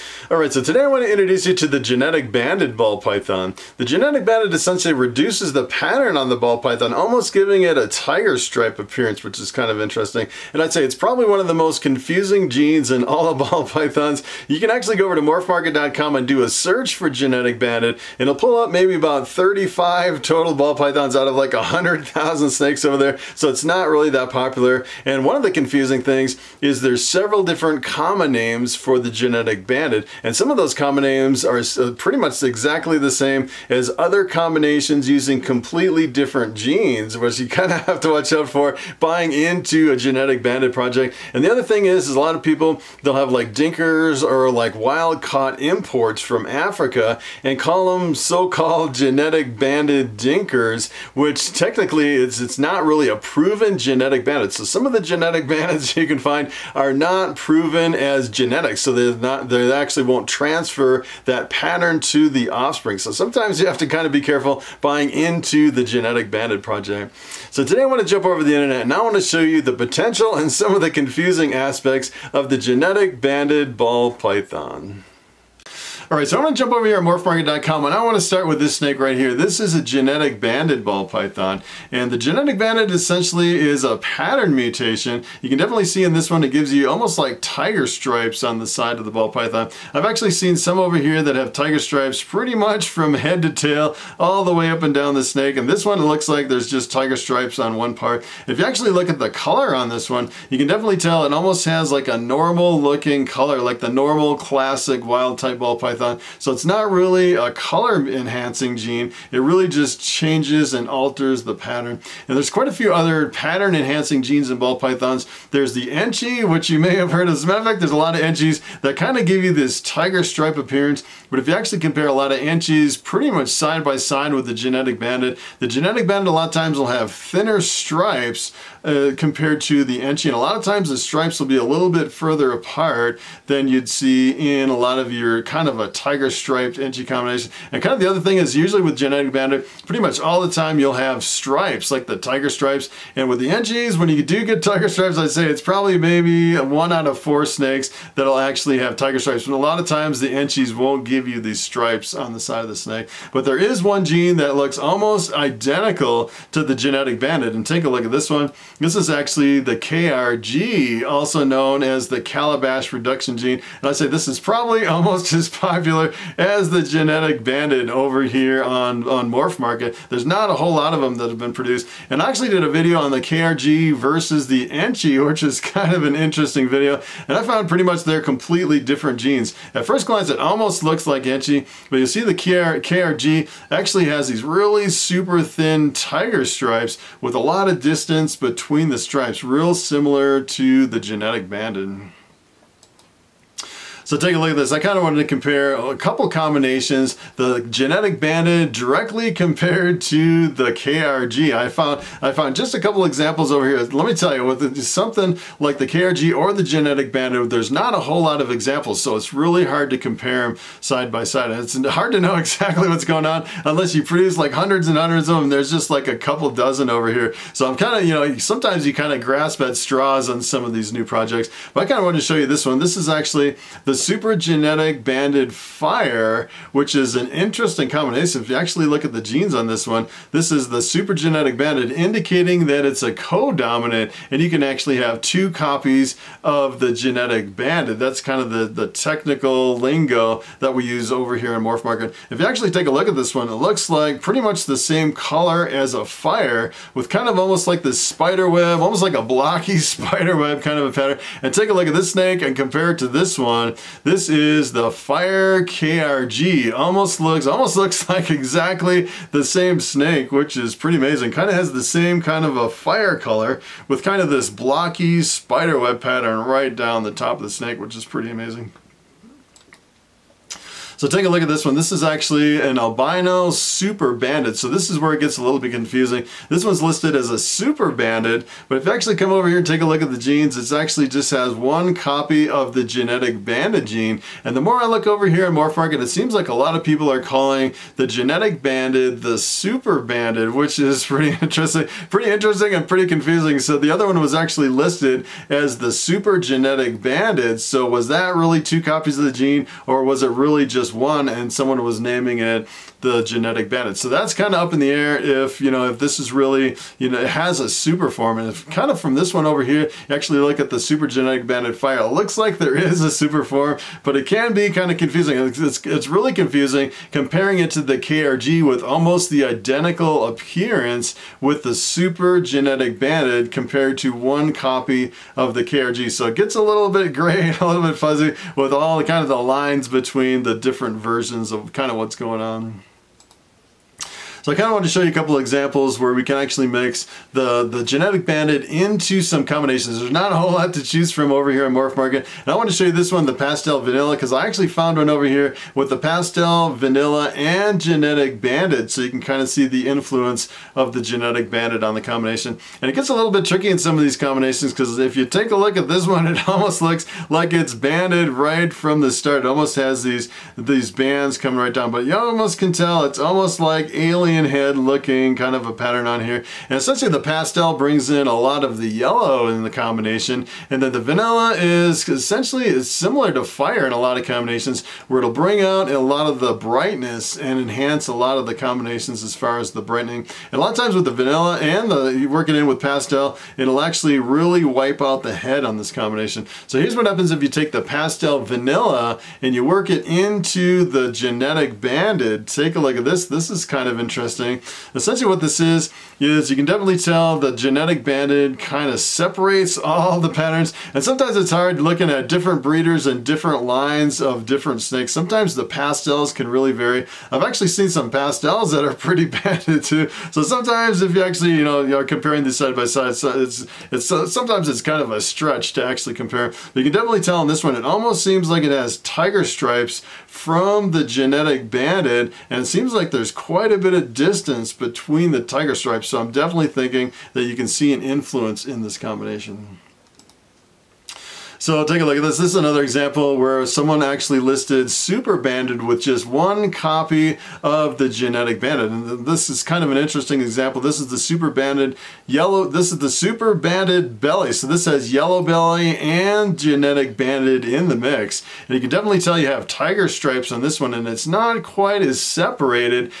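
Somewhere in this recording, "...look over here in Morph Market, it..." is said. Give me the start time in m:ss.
4:44.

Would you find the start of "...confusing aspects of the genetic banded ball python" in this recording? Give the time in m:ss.
1:10.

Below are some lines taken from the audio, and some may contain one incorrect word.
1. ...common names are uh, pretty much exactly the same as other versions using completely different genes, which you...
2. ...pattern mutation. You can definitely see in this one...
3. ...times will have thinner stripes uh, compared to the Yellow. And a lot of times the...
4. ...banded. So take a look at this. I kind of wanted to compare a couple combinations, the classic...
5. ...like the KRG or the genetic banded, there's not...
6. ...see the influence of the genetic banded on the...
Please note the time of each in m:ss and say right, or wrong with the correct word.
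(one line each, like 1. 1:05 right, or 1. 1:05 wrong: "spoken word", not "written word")
1. 0:30 wrong: "combinations", not "versions"
2. 1:23 right
3. 2:06 wrong: "Enchi", not "Yellow"
4. 3:11 wrong: "genetic", not "classic"
5. 3:25 right
6. 5:49 right.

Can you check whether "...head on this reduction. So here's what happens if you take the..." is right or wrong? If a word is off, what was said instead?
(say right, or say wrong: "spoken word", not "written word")
wrong: "combination", not "reduction".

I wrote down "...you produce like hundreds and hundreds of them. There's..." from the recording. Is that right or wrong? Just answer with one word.
right.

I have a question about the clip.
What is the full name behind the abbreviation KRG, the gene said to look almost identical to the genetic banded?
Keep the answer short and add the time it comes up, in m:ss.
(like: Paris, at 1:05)
Calabash reduction gene, at 2:42.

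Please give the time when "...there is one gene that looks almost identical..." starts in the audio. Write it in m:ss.
2:33.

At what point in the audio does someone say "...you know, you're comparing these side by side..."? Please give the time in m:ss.
6:51.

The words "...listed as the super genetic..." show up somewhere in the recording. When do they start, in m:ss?
4:54.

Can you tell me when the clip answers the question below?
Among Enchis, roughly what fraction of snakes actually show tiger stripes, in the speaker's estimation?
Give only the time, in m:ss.
2:26.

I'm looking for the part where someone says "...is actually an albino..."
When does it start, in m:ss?
4:31.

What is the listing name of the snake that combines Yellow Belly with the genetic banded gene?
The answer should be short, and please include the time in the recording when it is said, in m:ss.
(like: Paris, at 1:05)
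Super Banded Belly, at 7:23.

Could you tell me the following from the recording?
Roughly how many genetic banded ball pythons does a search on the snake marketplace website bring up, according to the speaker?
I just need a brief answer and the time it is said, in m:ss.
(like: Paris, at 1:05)
35, at 0:19.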